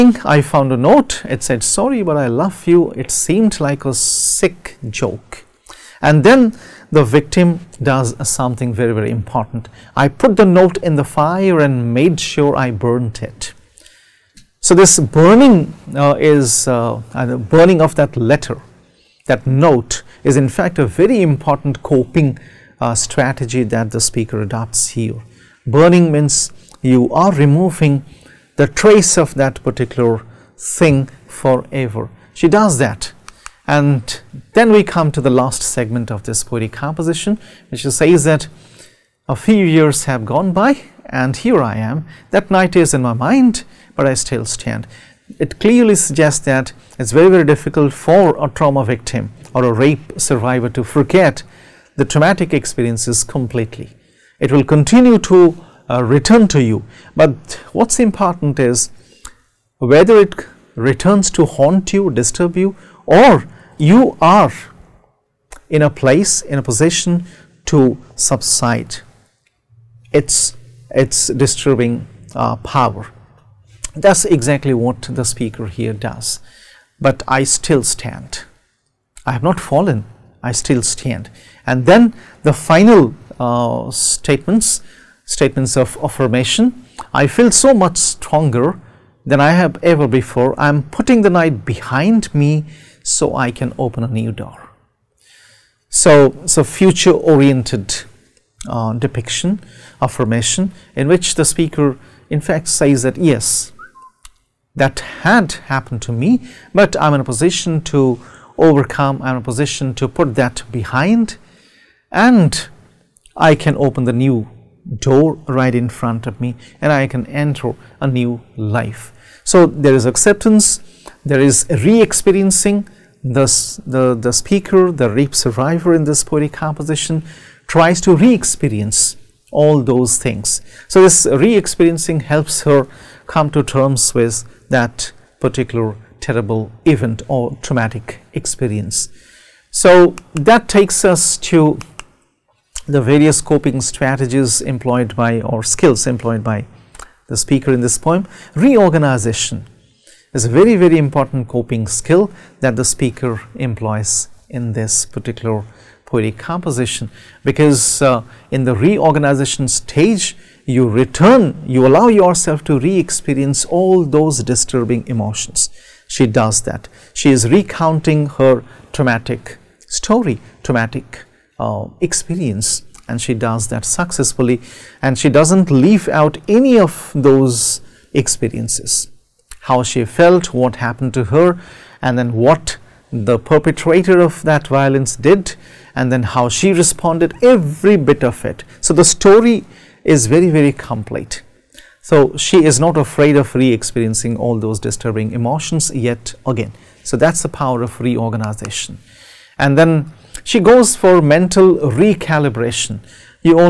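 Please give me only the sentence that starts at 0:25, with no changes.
Burning means you are removing the trace of that particular thing forever.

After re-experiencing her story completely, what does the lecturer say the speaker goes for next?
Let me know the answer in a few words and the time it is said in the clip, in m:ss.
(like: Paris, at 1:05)
Mental recalibration, at 3:21.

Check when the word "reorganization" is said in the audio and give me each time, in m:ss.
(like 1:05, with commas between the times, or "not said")
2:28, 2:38, 3:17.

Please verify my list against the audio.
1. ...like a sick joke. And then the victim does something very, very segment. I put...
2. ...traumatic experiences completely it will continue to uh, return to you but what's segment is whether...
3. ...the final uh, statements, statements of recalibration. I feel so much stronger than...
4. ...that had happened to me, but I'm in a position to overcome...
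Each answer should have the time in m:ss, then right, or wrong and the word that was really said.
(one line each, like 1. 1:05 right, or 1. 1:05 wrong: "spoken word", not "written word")
1. 0:03 wrong: "important", not "segment"
2. 0:52 wrong: "important", not "segment"
3. 1:22 wrong: "affirmation", not "recalibration"
4. 1:44 right.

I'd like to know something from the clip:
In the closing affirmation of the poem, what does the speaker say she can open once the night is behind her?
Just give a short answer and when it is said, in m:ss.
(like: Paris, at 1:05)
A new door, at 1:34.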